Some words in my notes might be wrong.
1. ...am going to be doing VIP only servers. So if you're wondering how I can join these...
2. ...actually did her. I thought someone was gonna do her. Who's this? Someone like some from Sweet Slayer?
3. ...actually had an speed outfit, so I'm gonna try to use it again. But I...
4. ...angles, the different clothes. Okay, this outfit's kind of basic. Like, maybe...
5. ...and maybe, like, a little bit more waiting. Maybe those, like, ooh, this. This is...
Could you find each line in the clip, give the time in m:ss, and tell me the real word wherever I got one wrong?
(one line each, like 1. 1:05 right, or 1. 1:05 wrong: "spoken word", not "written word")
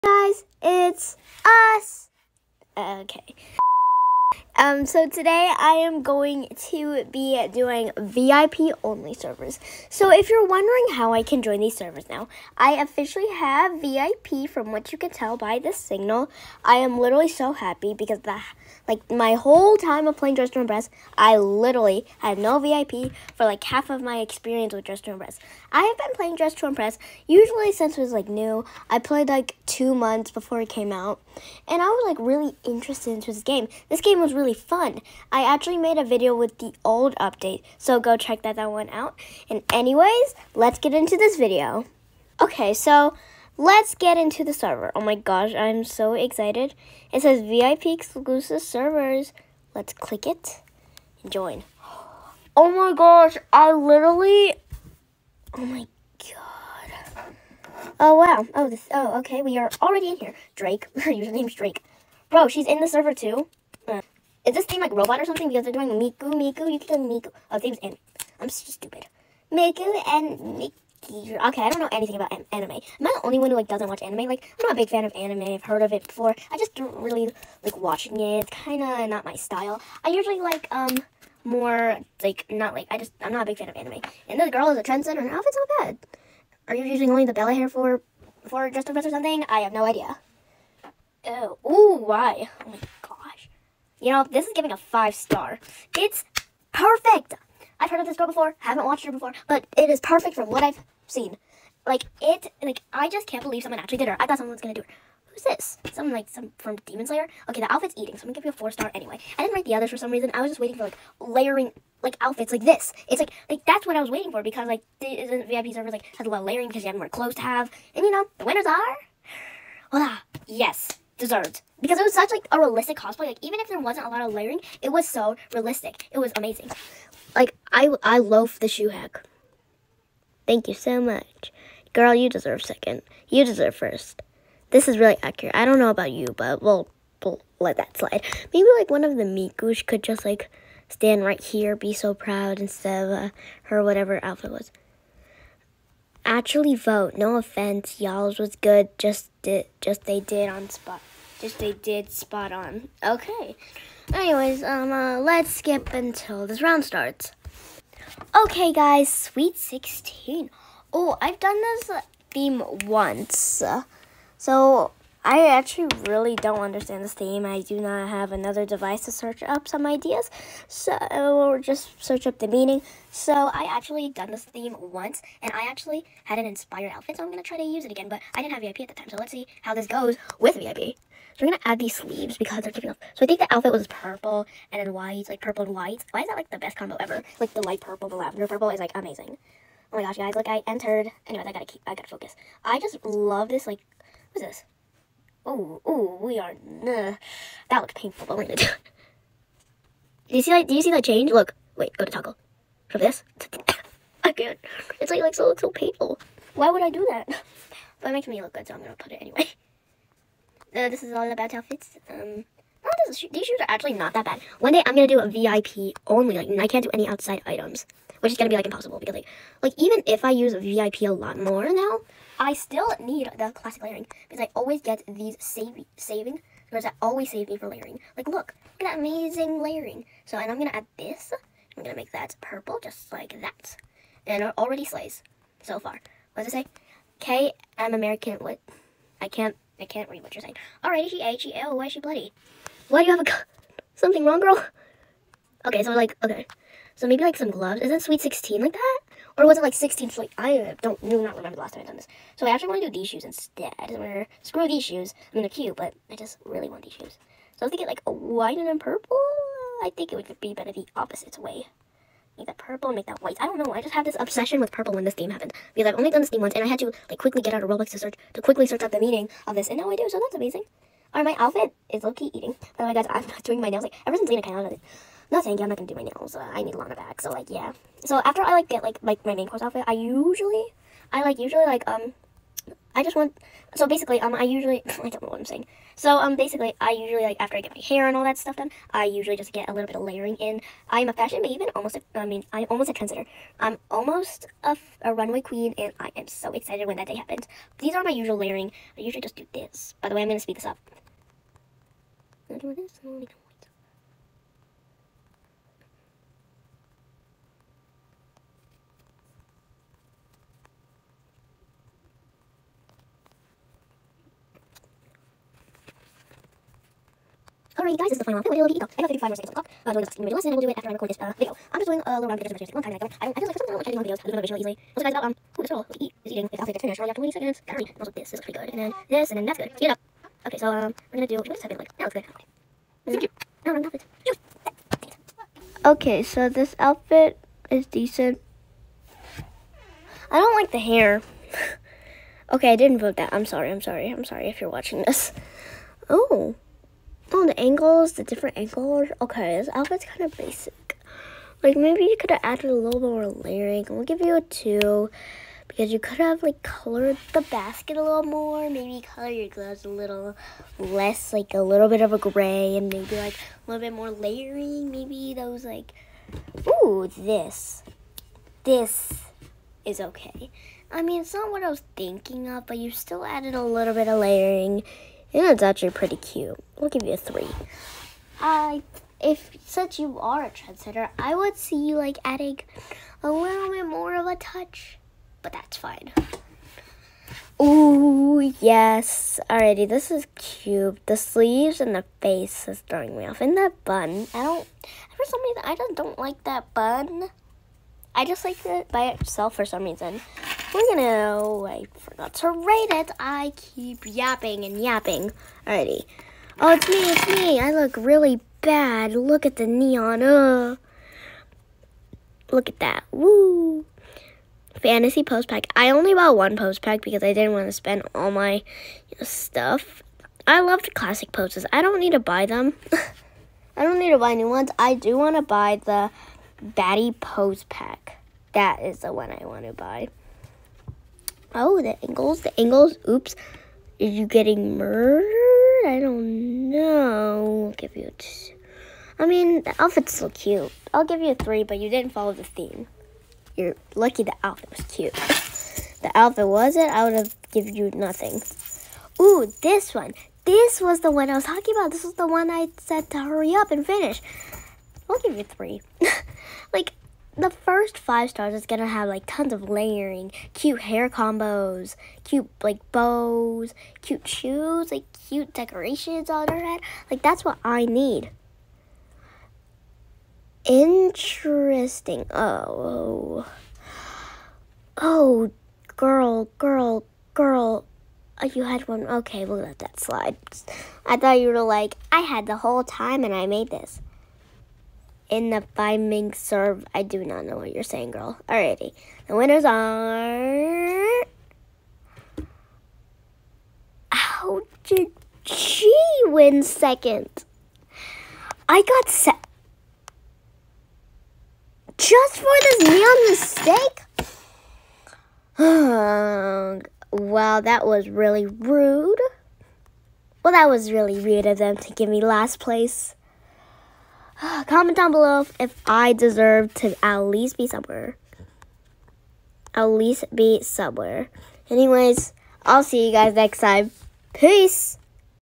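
1. 0:05 right
2. 1:43 wrong: "Demon", not "Sweet"
3. 2:55 wrong: "inspired", not "speed"
4. 5:47 wrong: "angles", not "clothes"
5. 6:02 wrong: "layering", not "waiting".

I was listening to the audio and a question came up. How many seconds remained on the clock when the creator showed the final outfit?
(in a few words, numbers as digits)
55.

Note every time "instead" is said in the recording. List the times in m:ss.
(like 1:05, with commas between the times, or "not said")
2:22, 4:13.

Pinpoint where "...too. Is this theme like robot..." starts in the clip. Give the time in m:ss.
1:03.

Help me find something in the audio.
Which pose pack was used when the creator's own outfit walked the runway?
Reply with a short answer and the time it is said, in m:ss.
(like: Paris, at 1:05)
Fantasy, at 6:54.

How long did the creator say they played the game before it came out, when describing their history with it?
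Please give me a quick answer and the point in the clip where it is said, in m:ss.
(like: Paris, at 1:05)
2 months, at 0:29.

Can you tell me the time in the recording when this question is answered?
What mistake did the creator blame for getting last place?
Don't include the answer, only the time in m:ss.
8:22.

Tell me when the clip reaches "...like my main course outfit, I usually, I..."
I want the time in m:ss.
4:39.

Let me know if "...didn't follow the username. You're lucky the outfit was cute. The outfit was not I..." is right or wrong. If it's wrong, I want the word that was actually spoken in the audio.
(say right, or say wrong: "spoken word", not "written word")
wrong: "theme", not "username".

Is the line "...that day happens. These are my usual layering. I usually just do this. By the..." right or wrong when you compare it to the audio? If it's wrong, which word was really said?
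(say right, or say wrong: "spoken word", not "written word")
right.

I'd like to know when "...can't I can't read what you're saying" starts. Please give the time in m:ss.
3:59.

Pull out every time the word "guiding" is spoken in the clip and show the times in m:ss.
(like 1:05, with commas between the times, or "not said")
not said.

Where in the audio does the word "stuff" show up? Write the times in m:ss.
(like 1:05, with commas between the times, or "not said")
4:48, 6:59.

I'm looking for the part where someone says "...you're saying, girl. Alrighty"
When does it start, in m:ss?
8:07.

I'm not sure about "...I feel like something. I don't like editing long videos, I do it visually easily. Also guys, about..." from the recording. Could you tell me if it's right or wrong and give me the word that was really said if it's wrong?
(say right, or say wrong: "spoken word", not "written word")
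right.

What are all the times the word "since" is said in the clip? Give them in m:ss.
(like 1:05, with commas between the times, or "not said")
0:27, 4:34, 6:19.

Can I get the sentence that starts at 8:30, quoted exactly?
Well, that was really rude of them to give me last place.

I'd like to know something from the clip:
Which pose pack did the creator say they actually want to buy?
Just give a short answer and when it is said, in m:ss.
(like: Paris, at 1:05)
Baddie Pose Pack, at 7:06.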